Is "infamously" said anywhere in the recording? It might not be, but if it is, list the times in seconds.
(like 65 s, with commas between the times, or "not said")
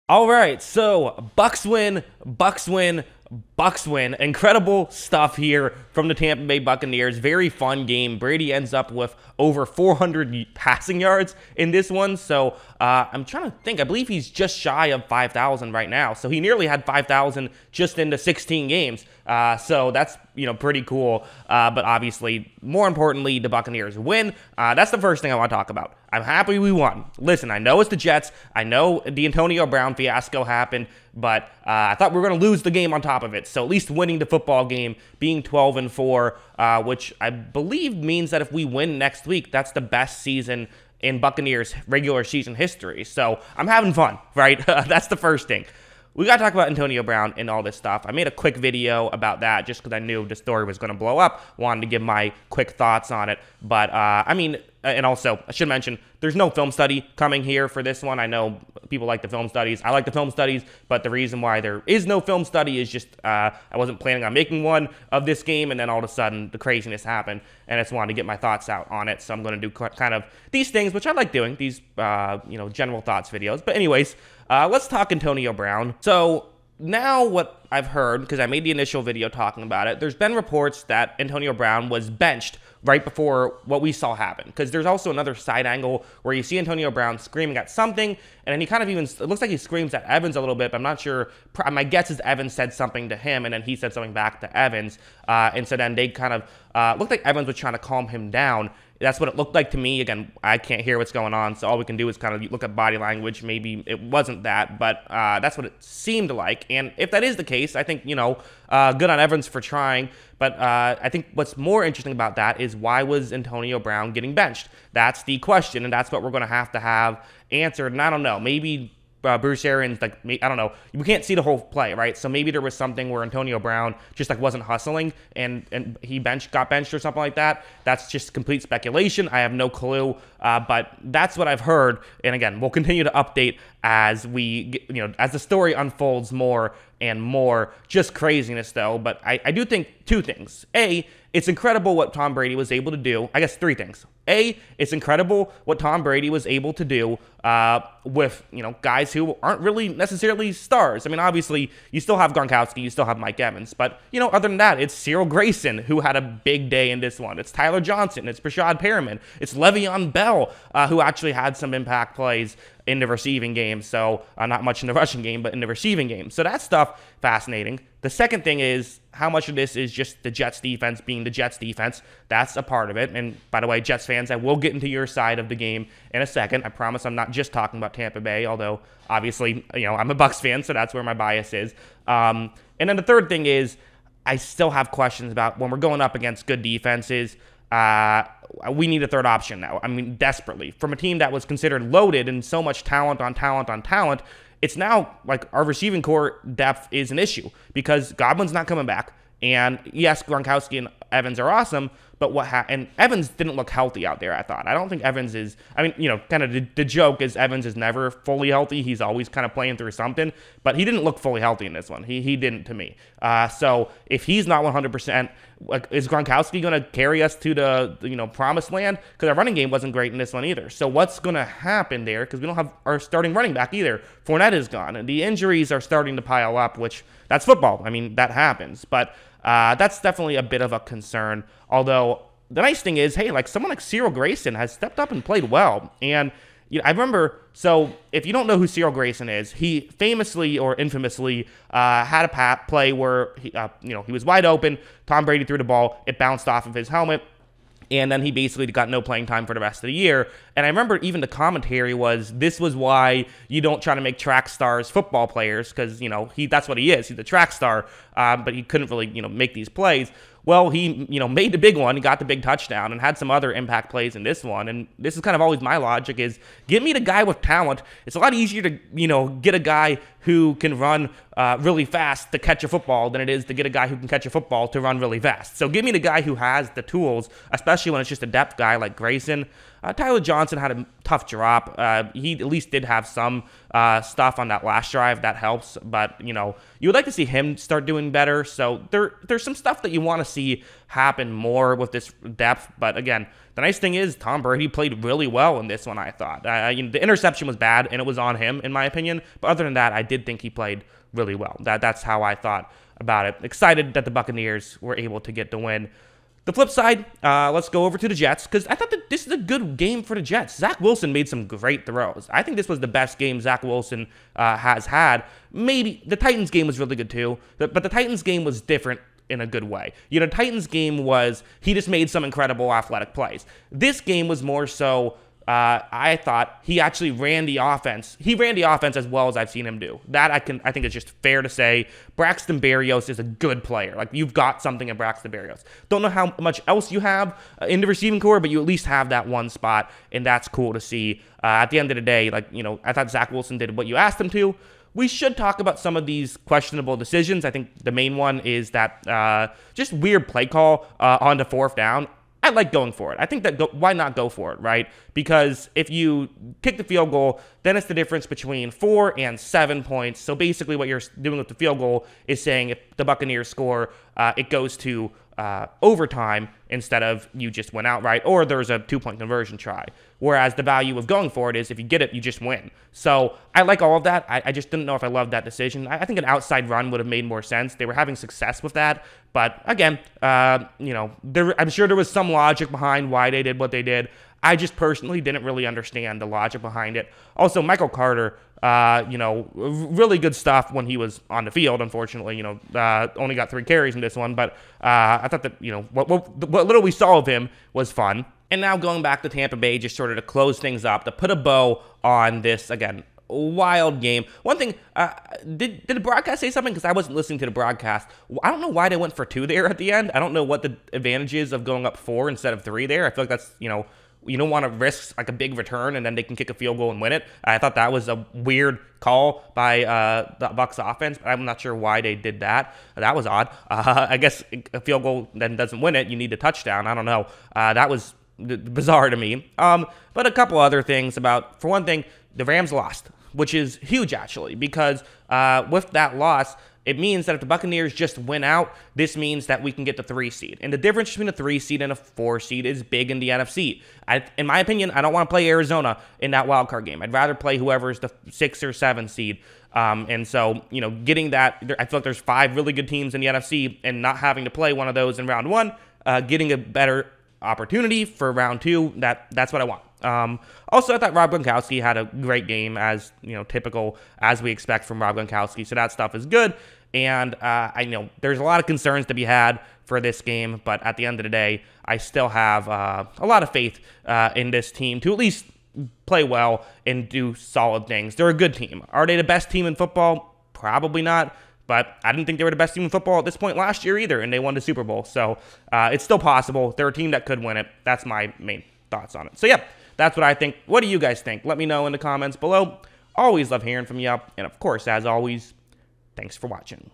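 240 s.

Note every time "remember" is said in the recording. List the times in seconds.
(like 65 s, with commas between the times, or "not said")
236 s, 250 s.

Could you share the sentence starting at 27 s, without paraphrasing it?
Listen, I know it's the Jets.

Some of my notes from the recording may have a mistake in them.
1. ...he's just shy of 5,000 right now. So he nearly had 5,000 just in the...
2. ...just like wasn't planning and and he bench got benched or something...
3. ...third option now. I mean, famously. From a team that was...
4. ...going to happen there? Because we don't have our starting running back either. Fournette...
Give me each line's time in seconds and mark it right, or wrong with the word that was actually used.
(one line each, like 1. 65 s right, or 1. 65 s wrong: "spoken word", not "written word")
1. 14 s right
2. 124 s wrong: "hustling", not "planning"
3. 189 s wrong: "desperately", not "famously"
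4. 221 s right.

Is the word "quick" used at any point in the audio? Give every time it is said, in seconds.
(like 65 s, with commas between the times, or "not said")
48 s, 52 s.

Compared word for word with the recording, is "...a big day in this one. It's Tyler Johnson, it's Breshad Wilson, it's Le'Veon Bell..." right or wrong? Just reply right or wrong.
wrong.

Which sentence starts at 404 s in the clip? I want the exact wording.
One thing, uh, did, did the broadcast say something?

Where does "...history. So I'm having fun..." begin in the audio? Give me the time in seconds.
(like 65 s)
42 s.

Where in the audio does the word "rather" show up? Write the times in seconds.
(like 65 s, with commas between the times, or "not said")
447 s.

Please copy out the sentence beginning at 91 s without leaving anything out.
My guess is Evans said something to him, and then he said something back to Evans.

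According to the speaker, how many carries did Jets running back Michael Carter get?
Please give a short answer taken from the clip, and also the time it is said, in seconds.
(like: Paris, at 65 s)
3, at 393 s.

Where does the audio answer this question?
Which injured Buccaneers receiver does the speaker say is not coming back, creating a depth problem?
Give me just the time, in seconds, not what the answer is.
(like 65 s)
198 s.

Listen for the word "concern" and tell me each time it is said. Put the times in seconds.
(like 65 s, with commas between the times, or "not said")
230 s, 468 s.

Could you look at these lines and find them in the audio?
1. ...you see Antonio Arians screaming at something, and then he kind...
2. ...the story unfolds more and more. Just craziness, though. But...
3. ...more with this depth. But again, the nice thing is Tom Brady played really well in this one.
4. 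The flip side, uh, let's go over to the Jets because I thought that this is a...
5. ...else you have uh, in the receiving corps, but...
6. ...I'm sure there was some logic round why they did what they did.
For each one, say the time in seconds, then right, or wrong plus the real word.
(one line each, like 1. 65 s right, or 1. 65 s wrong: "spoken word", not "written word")
1. 86 s wrong: "Brown", not "Arians"
2. 135 s right
3. 291 s right
4. 306 s right
5. 336 s right
6. 381 s wrong: "behind", not "round".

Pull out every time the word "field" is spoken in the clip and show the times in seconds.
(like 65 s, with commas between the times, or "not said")
356 s, 361 s, 391 s, 416 s, 424 s.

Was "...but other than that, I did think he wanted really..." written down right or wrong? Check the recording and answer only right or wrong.
wrong.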